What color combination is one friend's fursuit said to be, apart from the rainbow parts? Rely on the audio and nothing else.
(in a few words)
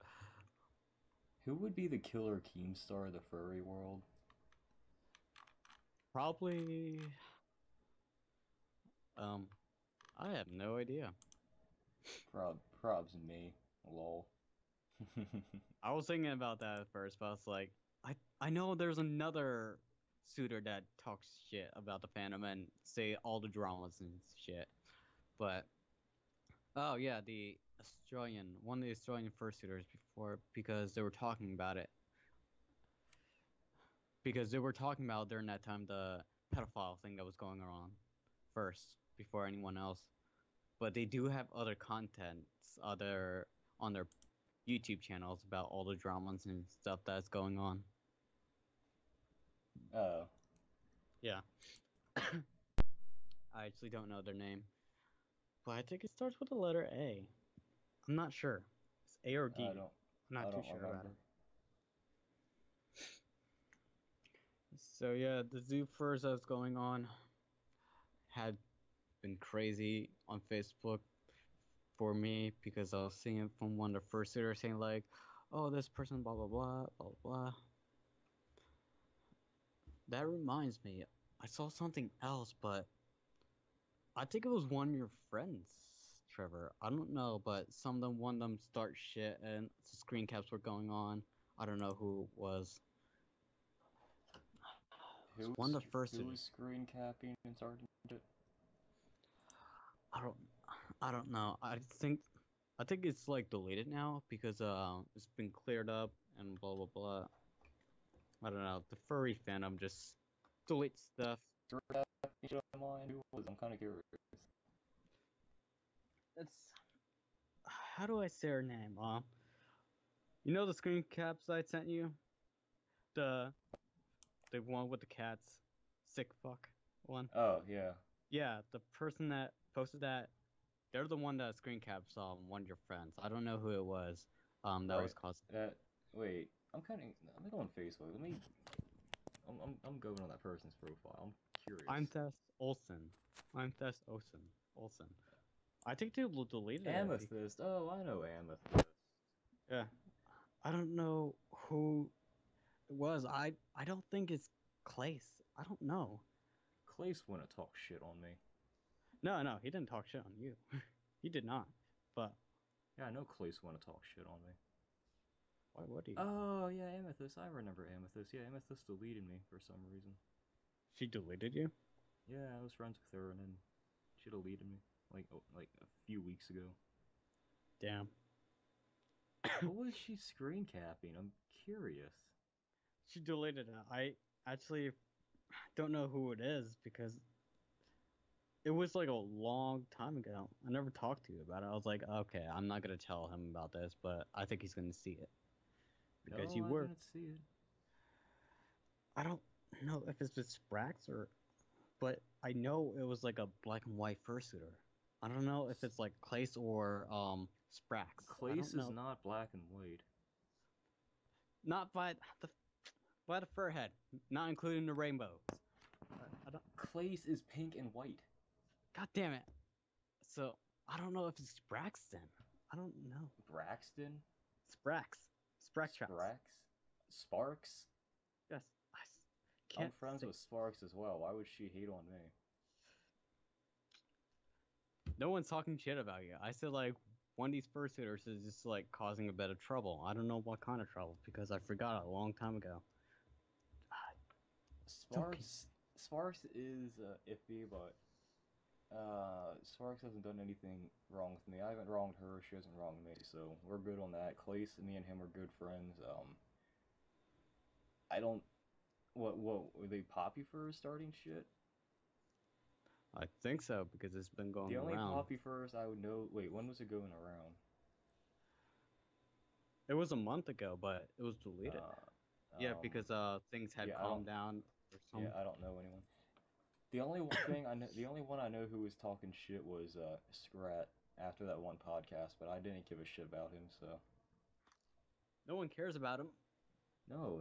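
pink and white.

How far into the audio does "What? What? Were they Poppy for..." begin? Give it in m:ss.
4:19.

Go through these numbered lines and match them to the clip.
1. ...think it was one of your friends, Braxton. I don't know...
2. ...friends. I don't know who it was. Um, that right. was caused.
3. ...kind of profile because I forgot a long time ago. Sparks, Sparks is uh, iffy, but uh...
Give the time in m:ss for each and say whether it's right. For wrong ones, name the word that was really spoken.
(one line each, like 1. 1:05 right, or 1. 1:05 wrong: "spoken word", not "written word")
1. 1:24 wrong: "Trevor", not "Braxton"
2. 2:12 right
3. 4:00 wrong: "trouble", not "profile".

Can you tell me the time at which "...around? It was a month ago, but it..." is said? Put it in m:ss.
4:27.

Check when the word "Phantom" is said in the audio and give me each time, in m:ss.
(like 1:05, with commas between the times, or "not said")
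0:22, 1:49.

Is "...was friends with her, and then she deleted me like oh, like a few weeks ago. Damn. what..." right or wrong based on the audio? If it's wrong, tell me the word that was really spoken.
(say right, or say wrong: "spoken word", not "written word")
right.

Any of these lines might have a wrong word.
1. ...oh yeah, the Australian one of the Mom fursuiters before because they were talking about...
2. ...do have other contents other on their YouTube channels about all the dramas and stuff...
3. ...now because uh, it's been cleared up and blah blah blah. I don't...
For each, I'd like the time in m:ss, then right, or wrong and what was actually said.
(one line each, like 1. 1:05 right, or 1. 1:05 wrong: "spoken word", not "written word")
1. 0:26 wrong: "Australian", not "Mom"
2. 0:41 right
3. 1:43 right.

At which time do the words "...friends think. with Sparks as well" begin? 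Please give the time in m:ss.
3:49.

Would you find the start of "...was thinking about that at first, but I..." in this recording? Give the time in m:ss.
0:15.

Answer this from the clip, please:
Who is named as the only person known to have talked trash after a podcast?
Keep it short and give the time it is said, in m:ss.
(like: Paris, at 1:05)
Scrat, at 4:40.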